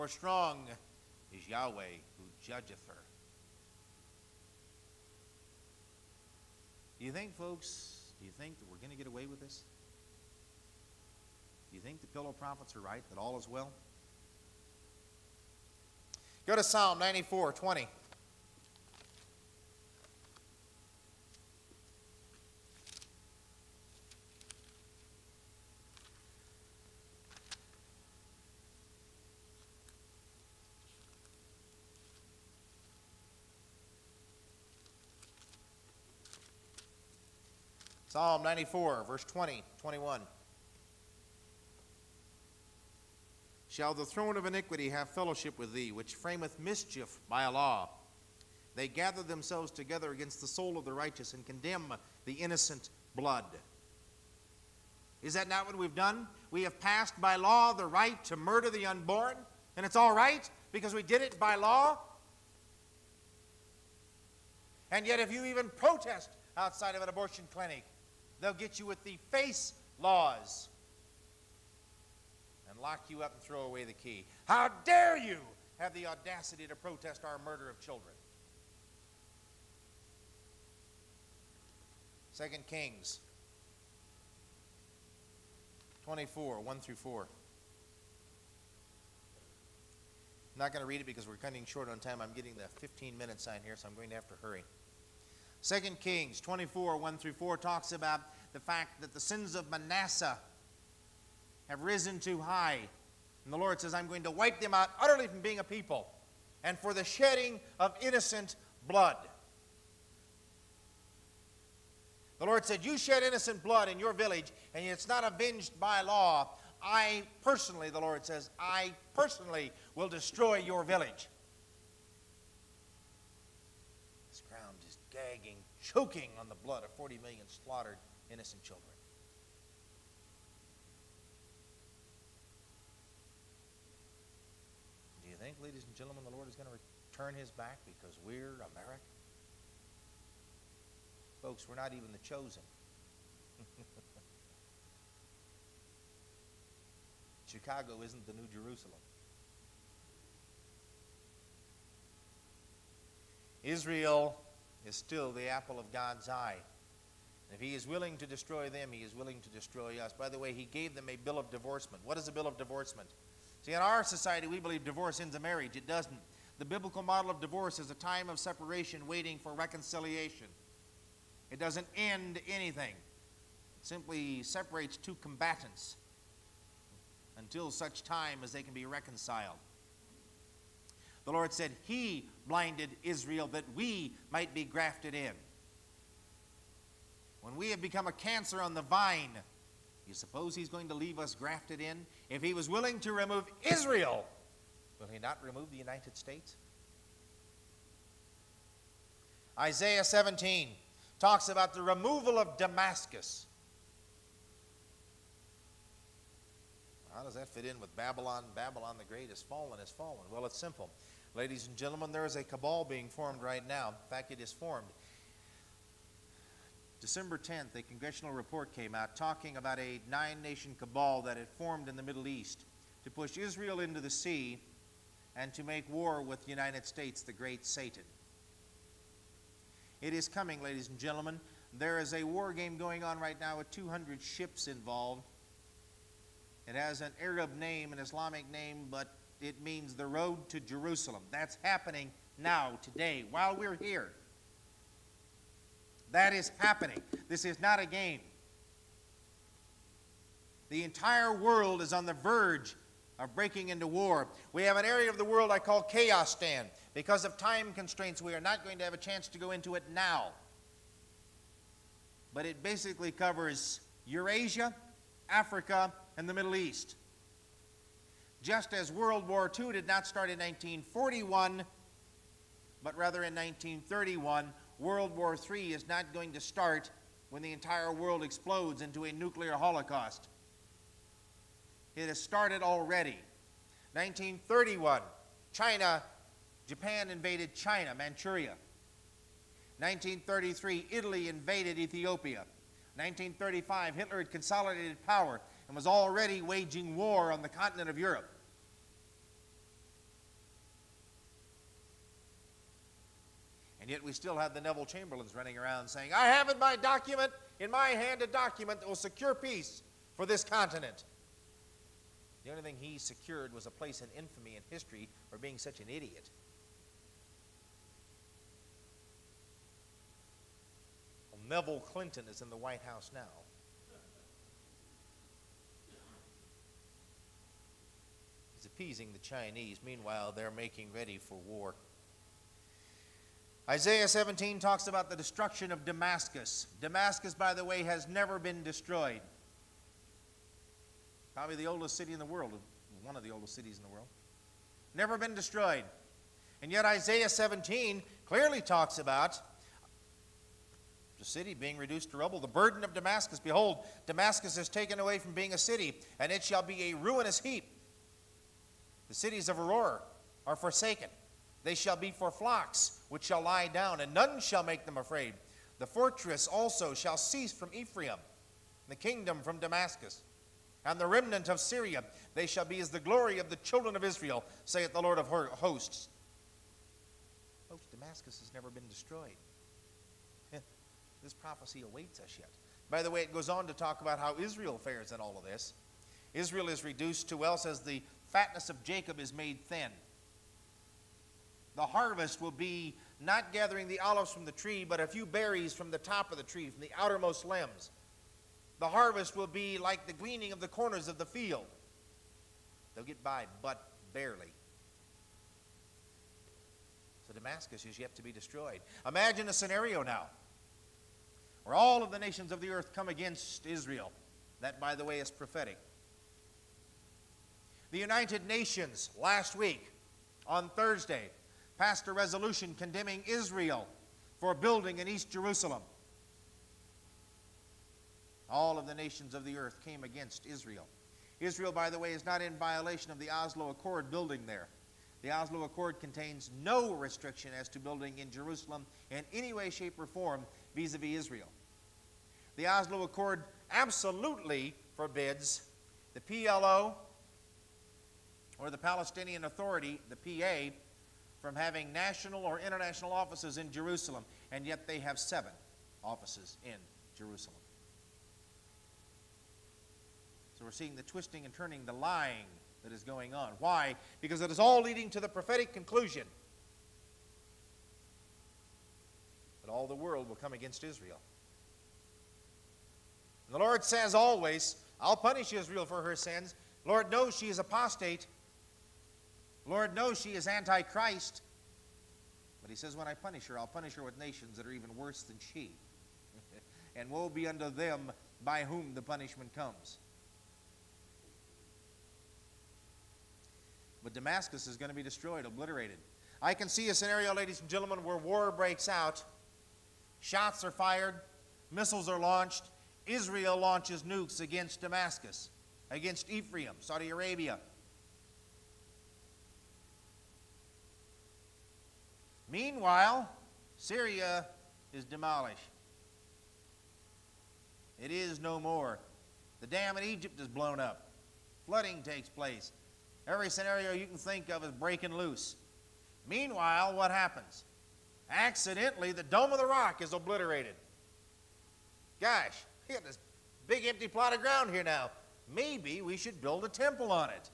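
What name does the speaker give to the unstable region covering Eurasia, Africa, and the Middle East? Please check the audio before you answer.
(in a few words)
Chaostan.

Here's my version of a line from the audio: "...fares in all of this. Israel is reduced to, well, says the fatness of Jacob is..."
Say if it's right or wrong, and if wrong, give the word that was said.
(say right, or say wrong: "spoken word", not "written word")
right.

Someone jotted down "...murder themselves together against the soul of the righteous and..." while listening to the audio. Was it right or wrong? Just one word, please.
wrong.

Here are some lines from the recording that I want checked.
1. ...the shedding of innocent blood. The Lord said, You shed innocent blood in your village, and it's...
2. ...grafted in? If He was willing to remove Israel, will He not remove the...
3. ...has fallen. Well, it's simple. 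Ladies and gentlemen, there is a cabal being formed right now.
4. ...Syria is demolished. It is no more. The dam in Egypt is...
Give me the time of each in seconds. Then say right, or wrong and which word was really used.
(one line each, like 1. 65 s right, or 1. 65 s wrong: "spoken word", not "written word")
1. 106 s right
2. 191 s right
3. 209 s right
4. 513 s right.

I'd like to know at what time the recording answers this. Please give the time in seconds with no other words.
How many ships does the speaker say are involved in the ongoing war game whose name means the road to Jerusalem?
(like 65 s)
233 s.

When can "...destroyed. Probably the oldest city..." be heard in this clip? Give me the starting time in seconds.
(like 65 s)
338 s.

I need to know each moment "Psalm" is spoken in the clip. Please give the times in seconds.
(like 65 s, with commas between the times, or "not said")
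16 s, 38 s.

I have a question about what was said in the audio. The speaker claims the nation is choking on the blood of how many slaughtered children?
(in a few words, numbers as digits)
40 million.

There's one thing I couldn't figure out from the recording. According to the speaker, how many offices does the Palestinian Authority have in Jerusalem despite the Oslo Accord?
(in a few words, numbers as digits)
7.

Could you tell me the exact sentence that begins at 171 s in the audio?
It doesn't end anything, it simply separates two combatants until such time as they can be reconciled.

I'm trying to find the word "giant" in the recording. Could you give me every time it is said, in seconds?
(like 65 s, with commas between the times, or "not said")
not said.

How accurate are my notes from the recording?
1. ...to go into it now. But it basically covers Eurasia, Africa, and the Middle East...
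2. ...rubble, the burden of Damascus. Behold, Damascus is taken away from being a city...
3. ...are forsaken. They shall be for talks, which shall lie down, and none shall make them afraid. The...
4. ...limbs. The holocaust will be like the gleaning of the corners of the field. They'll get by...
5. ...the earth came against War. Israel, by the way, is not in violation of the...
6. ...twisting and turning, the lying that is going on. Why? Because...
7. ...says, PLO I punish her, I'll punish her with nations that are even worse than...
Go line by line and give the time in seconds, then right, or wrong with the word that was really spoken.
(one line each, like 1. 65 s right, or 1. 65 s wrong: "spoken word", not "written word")
1. 259 s right
2. 352 s right
3. 360 s wrong: "flocks", not "talks"
4. 397 s wrong: "harvest", not "holocaust"
5. 429 s wrong: "Israel", not "War"
6. 461 s right
7. 482 s wrong: "When", not "PLO".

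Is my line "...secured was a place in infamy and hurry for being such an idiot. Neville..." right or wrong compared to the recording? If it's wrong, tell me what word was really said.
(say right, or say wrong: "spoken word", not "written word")
wrong: "history", not "hurry".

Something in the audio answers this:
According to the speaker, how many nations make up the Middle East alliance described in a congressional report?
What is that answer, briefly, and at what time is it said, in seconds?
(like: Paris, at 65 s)
9, at 220 s.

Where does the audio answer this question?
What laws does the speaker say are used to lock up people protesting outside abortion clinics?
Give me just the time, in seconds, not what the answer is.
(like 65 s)
69 s.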